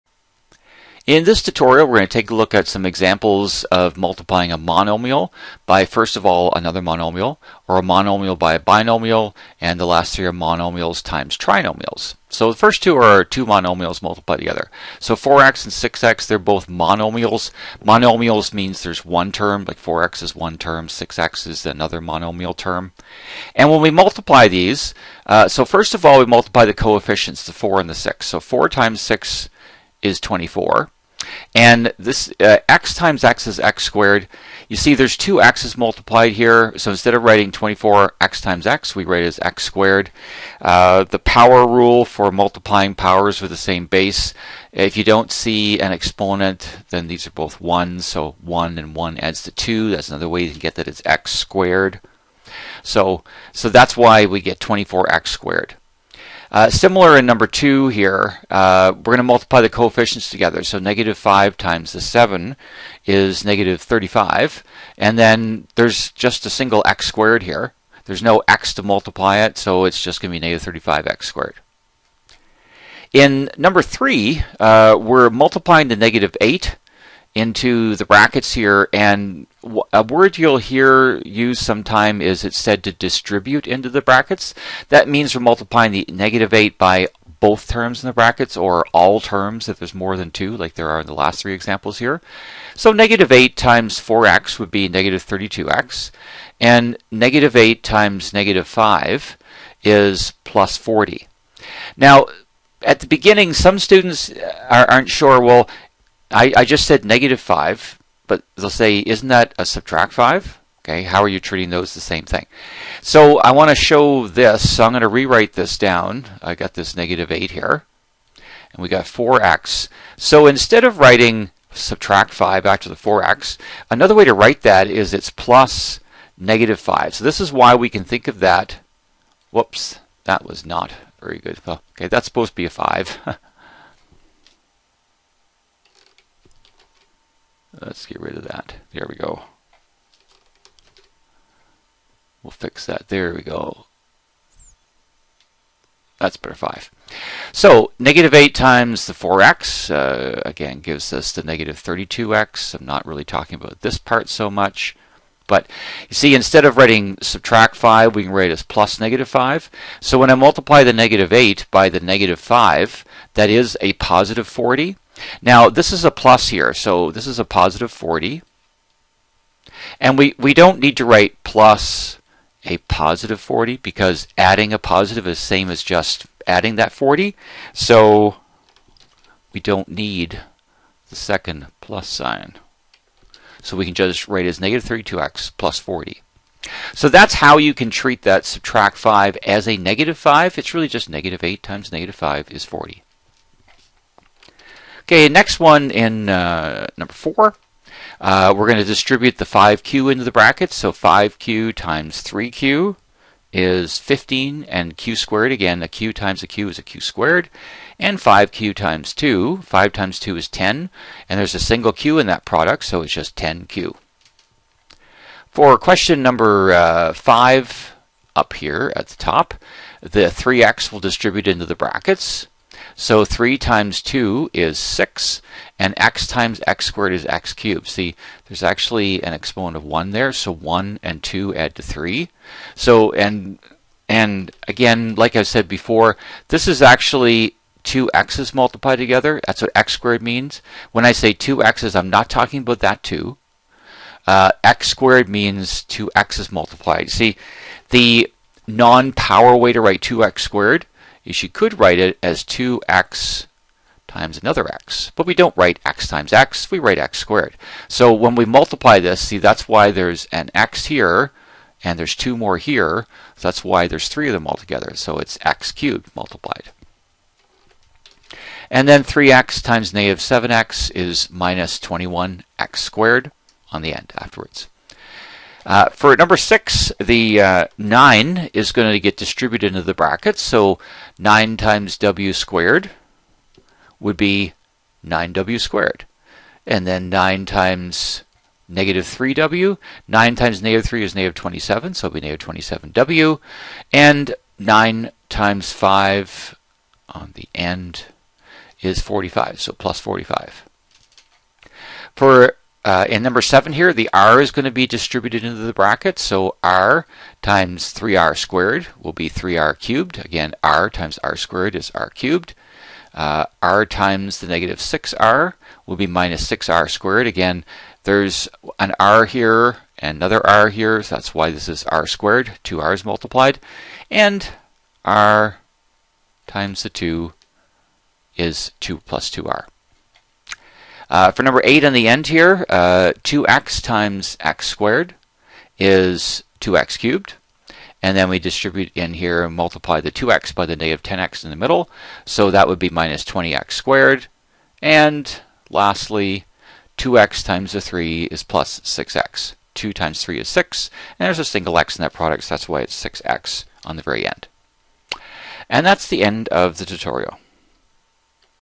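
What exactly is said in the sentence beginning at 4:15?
But we don't write x times x, we write x squared.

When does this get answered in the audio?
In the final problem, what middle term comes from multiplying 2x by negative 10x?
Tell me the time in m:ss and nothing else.
5:42.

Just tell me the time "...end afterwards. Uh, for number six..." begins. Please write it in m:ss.
4:33.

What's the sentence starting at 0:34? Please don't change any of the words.
You see there's two x's multiplied here.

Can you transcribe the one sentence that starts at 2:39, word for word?
So when I multiply the negative 8 by the negative 5, that is a positive 40.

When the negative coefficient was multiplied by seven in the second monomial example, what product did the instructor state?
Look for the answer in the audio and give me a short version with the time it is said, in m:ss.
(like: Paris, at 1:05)
-35, at 1:03.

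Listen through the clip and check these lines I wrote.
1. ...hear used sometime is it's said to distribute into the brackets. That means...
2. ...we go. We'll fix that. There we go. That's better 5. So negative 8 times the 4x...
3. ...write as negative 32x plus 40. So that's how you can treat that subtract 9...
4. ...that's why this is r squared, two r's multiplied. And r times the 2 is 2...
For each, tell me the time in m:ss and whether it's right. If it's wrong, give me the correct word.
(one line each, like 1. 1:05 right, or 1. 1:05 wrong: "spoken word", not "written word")
1. 1:20 right
2. 2:19 right
3. 3:04 wrong: "5", not "9"
4. 5:21 right.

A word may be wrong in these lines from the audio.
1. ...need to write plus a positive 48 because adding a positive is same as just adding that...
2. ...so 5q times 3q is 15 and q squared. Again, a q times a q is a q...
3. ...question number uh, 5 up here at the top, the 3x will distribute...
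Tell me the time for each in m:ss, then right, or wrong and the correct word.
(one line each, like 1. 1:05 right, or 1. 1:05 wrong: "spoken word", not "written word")
1. 2:50 wrong: "40", not "48"
2. 3:20 right
3. 3:35 right.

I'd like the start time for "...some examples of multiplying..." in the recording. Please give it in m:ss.
0:02.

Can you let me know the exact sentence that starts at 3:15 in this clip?
Okay, next one in uh, number four.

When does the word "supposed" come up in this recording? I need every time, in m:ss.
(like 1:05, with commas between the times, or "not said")
2:12.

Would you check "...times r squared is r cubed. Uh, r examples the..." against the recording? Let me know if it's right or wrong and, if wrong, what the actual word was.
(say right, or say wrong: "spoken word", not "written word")
wrong: "times", not "examples".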